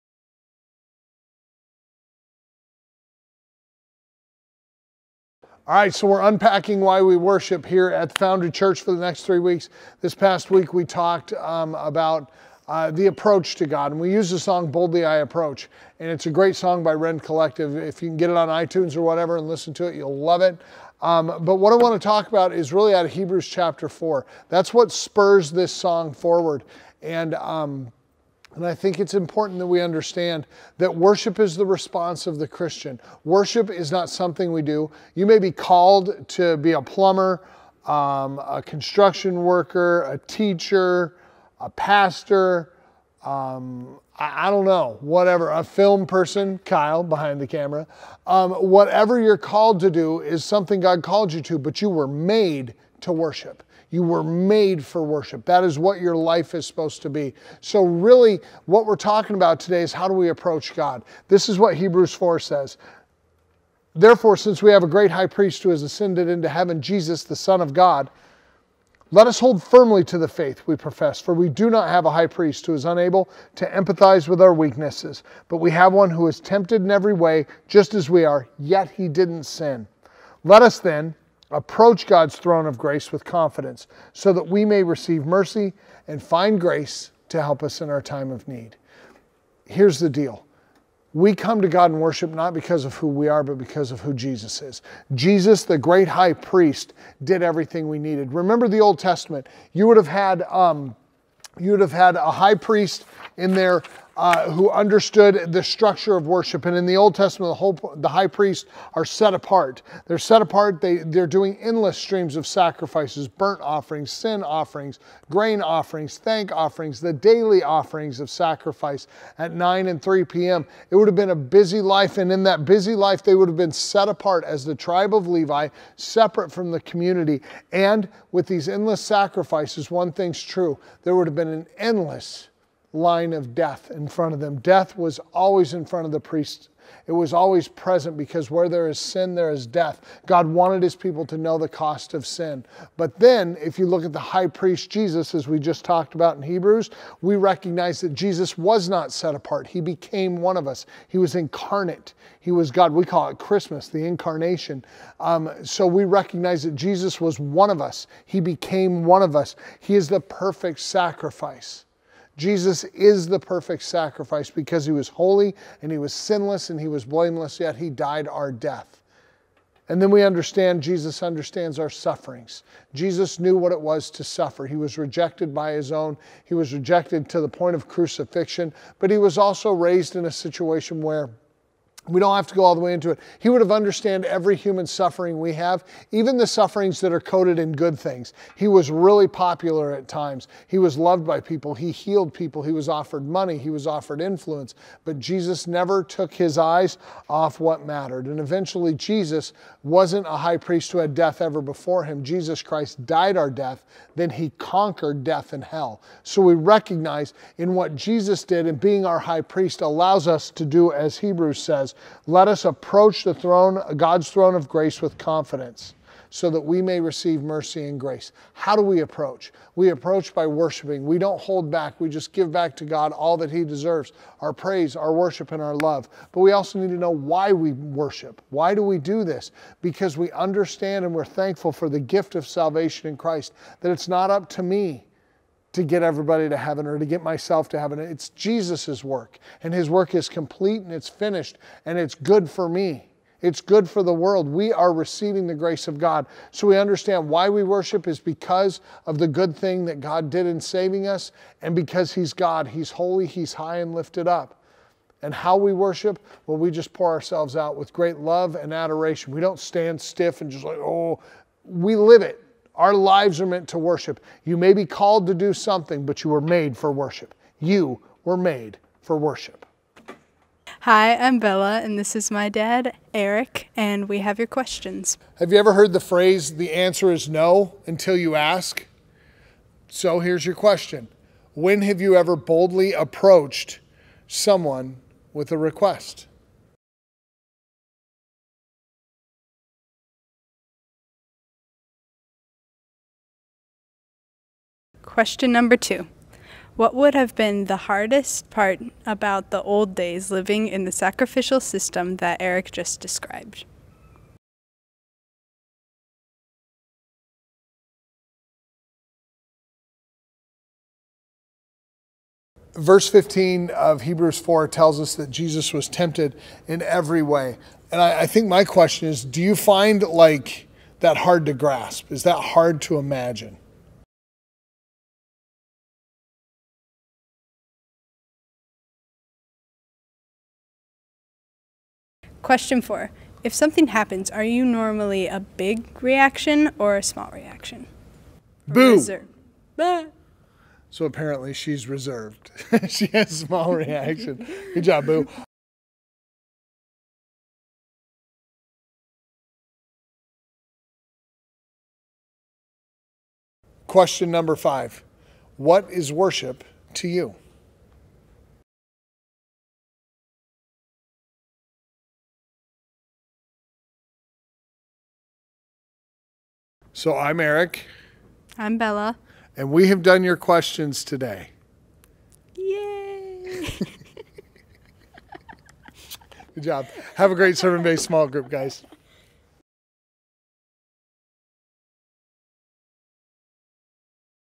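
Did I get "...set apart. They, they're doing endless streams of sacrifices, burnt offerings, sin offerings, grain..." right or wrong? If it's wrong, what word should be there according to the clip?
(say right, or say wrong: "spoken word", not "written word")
right.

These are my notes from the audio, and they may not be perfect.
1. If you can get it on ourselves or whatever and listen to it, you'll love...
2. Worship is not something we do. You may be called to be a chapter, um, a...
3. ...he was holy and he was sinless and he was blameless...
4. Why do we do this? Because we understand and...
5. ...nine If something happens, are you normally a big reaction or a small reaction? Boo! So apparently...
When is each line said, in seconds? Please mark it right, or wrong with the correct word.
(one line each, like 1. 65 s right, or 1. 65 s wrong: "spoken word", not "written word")
1. 17 s wrong: "iTunes", not "ourselves"
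2. 33 s wrong: "plumber", not "chapter"
3. 164 s right
4. 228 s right
5. 332 s wrong: "four", not "nine".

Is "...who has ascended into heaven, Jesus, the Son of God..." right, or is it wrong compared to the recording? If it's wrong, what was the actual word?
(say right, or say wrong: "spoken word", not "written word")
right.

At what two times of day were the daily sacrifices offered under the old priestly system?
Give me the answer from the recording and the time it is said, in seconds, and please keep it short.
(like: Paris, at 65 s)
9 and 3 p.m., at 119 s.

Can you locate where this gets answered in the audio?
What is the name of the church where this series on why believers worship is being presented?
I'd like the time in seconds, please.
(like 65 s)
8 s.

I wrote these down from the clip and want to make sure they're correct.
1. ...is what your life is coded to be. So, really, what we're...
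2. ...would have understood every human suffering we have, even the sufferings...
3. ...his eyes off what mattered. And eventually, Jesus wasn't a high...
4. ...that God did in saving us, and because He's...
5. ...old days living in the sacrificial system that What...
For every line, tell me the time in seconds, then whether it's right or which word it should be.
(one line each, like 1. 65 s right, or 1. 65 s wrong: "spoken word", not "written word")
1. 55 s wrong: "supposed", not "coded"
2. 183 s right
3. 196 s right
4. 249 s right
5. 299 s wrong: "Eric", not "What".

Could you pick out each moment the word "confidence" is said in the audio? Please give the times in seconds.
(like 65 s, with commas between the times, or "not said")
83 s, 215 s.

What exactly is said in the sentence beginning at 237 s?
It's Jesus' work, and his work is complete and it's finished, and it's good for me.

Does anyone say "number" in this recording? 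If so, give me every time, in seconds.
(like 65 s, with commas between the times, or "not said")
295 s, 354 s.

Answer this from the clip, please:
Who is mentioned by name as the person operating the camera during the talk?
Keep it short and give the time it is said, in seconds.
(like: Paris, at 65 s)
Kyle, at 46 s.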